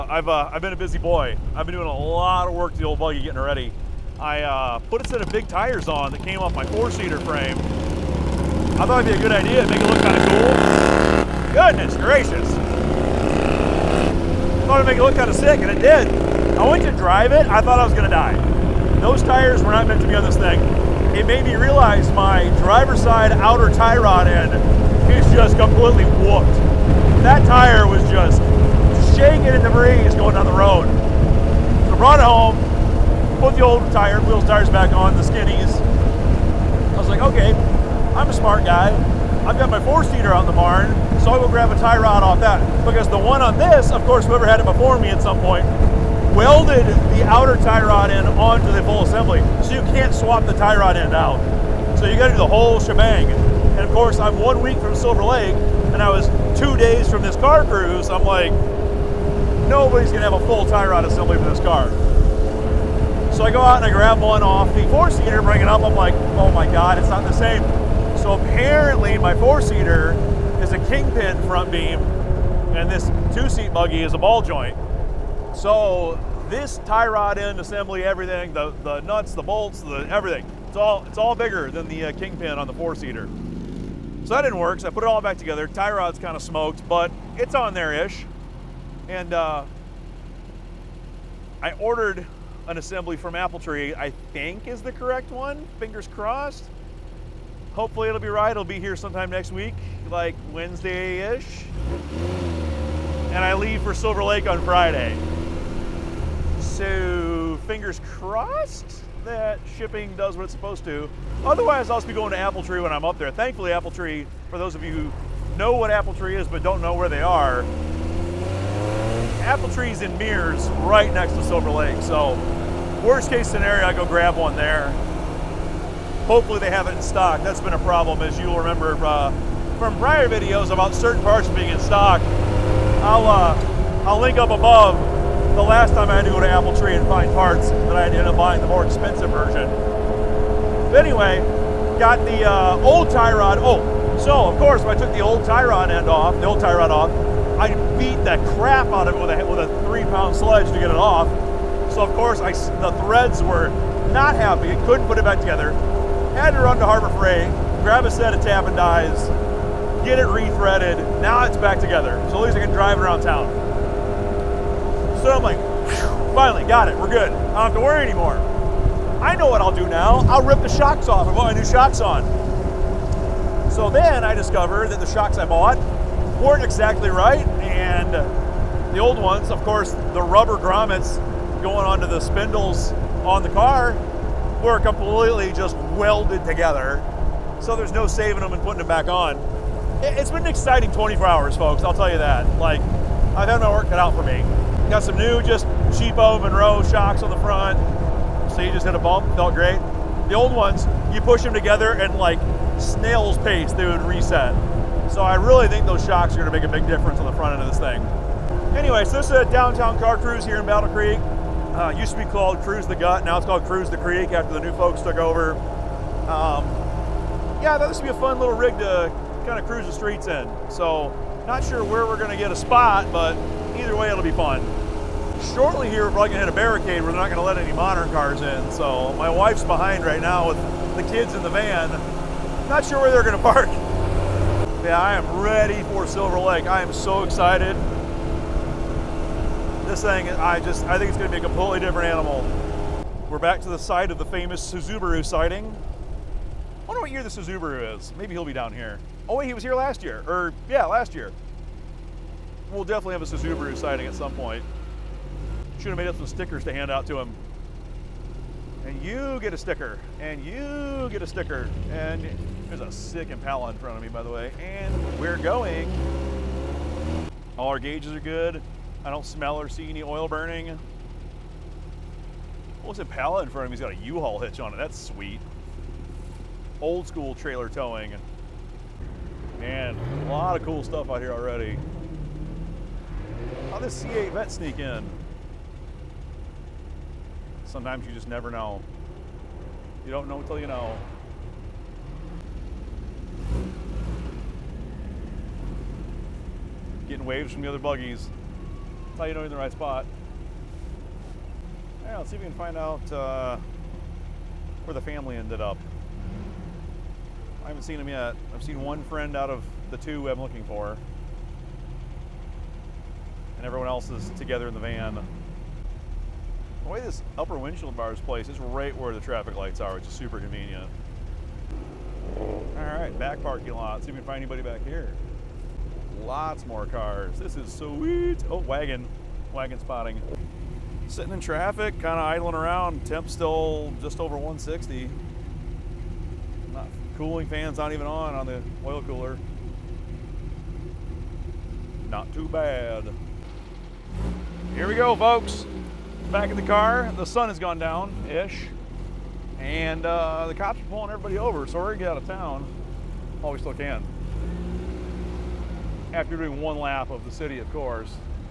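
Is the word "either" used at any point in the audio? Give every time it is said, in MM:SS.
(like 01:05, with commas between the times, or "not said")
03:43.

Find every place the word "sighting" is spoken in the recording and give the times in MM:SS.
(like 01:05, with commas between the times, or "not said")
04:05, 04:13.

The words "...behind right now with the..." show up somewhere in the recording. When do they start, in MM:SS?
03:49.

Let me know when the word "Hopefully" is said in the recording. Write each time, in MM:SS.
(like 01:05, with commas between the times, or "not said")
01:37, 02:06.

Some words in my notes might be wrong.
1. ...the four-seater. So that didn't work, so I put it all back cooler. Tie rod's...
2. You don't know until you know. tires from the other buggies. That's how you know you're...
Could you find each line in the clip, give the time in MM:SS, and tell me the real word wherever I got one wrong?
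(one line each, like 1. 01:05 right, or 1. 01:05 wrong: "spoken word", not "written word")
1. 01:22 wrong: "together", not "cooler"
2. 04:50 wrong: "waves", not "tires".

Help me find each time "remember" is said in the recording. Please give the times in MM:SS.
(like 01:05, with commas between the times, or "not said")
02:08.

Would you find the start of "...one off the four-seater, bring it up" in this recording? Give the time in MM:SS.
01:04.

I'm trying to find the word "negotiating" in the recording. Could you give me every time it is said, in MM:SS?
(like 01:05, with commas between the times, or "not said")
not said.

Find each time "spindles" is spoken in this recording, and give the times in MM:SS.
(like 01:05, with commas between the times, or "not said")
03:02.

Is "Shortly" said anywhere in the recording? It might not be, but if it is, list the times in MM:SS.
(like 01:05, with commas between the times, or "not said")
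03:45.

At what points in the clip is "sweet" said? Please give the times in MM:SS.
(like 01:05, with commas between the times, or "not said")
04:34, 05:27.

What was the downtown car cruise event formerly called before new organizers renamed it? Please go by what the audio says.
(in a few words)
Cruise the Gut.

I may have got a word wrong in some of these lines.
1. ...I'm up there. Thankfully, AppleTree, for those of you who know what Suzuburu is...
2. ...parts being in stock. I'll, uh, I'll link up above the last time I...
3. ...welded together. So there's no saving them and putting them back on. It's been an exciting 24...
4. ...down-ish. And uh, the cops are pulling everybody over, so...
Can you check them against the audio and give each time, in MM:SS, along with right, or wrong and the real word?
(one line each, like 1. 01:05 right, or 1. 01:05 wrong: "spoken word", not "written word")
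1. 01:52 wrong: "AppleTree", not "Suzuburu"
2. 02:11 right
3. 03:05 right
4. 05:47 right.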